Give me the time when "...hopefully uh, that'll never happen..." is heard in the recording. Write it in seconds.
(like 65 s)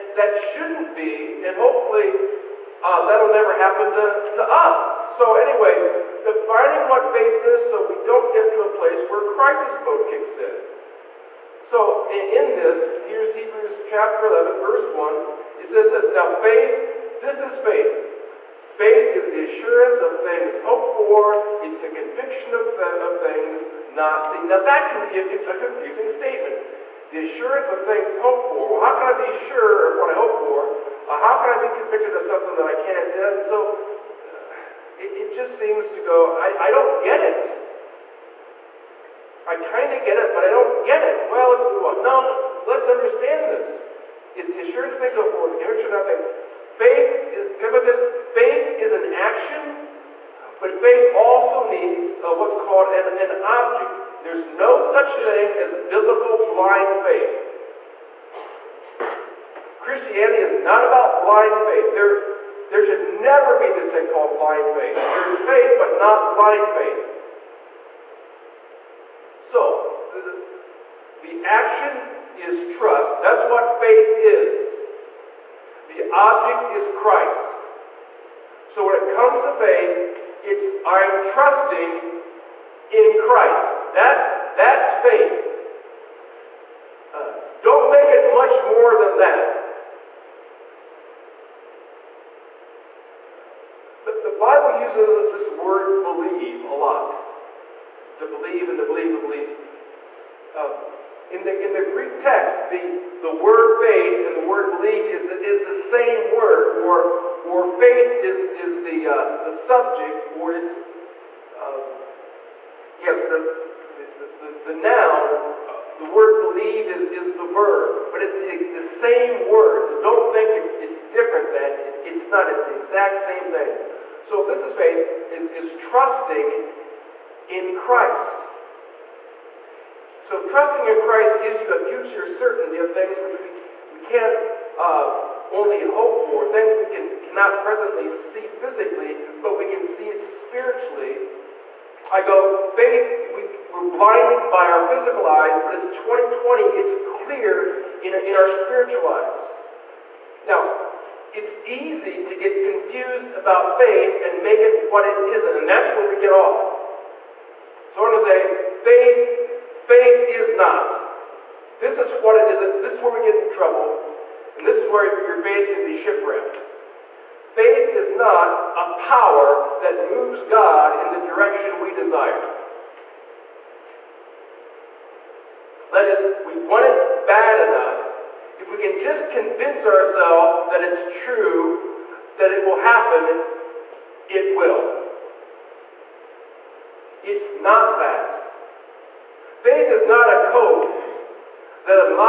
1 s.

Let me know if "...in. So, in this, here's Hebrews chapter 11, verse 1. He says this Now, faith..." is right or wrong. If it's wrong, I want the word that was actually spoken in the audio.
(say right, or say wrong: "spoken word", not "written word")
right.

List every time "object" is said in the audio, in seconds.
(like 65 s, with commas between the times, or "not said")
53 s, 76 s.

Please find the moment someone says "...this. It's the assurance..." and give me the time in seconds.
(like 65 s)
43 s.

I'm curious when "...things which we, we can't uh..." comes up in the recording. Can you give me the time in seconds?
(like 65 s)
132 s.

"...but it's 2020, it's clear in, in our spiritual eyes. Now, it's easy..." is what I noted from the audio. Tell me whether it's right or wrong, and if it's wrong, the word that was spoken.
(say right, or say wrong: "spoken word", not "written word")
right.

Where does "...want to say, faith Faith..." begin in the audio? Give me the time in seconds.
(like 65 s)
158 s.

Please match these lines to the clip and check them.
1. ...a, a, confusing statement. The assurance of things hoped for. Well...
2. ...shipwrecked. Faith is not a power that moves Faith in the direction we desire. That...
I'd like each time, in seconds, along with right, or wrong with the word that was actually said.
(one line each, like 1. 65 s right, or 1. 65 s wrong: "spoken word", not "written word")
1. 25 s right
2. 166 s wrong: "God", not "Faith".